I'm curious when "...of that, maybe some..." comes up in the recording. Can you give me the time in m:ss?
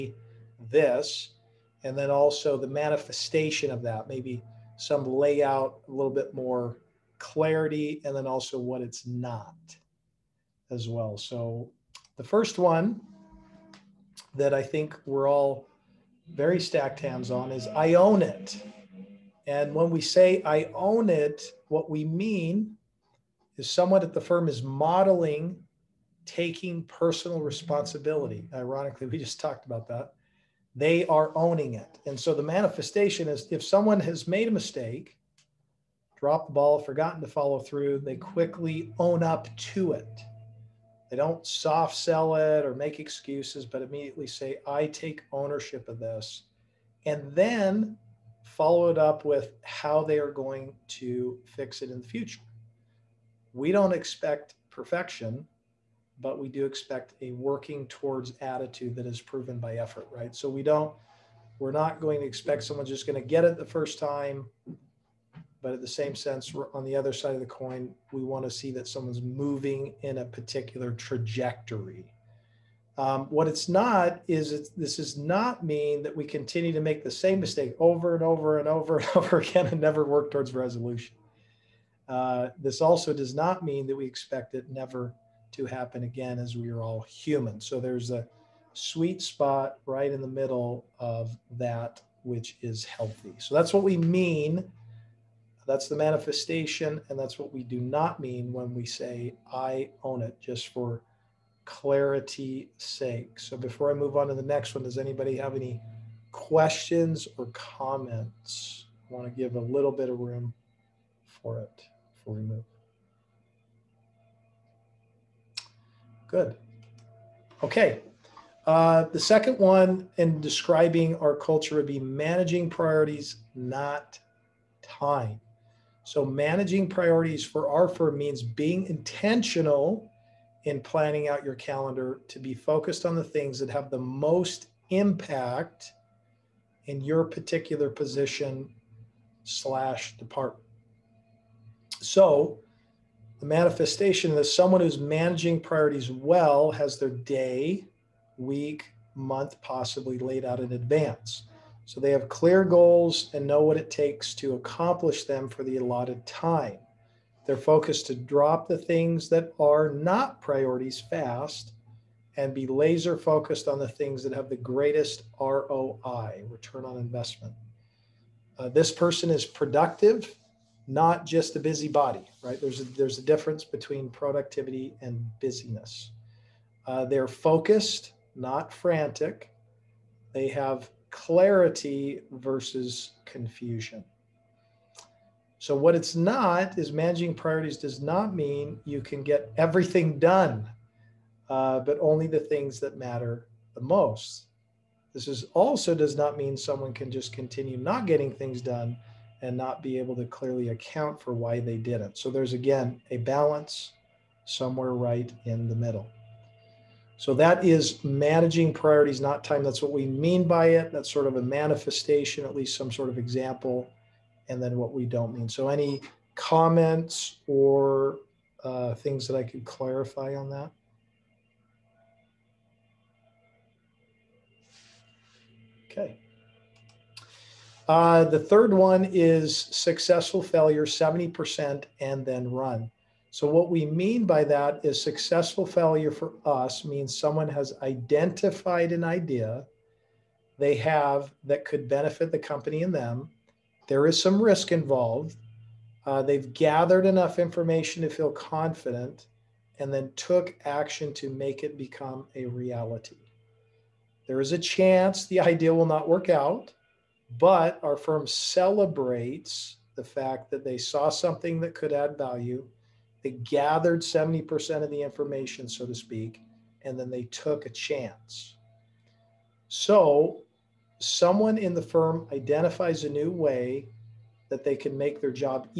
0:03.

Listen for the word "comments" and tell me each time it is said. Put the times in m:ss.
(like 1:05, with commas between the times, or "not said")
1:47, 3:36.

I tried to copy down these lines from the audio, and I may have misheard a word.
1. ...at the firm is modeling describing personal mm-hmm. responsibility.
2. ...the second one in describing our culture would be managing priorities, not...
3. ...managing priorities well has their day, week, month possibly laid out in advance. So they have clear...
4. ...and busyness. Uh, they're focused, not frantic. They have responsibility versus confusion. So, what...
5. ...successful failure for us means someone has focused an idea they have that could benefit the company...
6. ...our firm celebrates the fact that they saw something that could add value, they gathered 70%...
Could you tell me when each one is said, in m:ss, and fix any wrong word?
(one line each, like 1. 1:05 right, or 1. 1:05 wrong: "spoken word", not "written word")
1. 0:24 wrong: "taking", not "describing"
2. 1:59 right
3. 2:24 right
4. 2:55 wrong: "clarity", not "responsibility"
5. 3:55 wrong: "identified", not "focused"
6. 4:17 right.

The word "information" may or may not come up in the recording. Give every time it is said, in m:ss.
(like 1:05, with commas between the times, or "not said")
4:07, 4:25.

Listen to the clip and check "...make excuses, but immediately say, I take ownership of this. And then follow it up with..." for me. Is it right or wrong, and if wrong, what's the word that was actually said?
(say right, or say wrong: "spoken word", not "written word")
right.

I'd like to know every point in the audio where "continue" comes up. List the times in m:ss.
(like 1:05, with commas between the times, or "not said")
1:16, 3:17.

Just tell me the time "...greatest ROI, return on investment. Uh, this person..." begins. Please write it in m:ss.
2:44.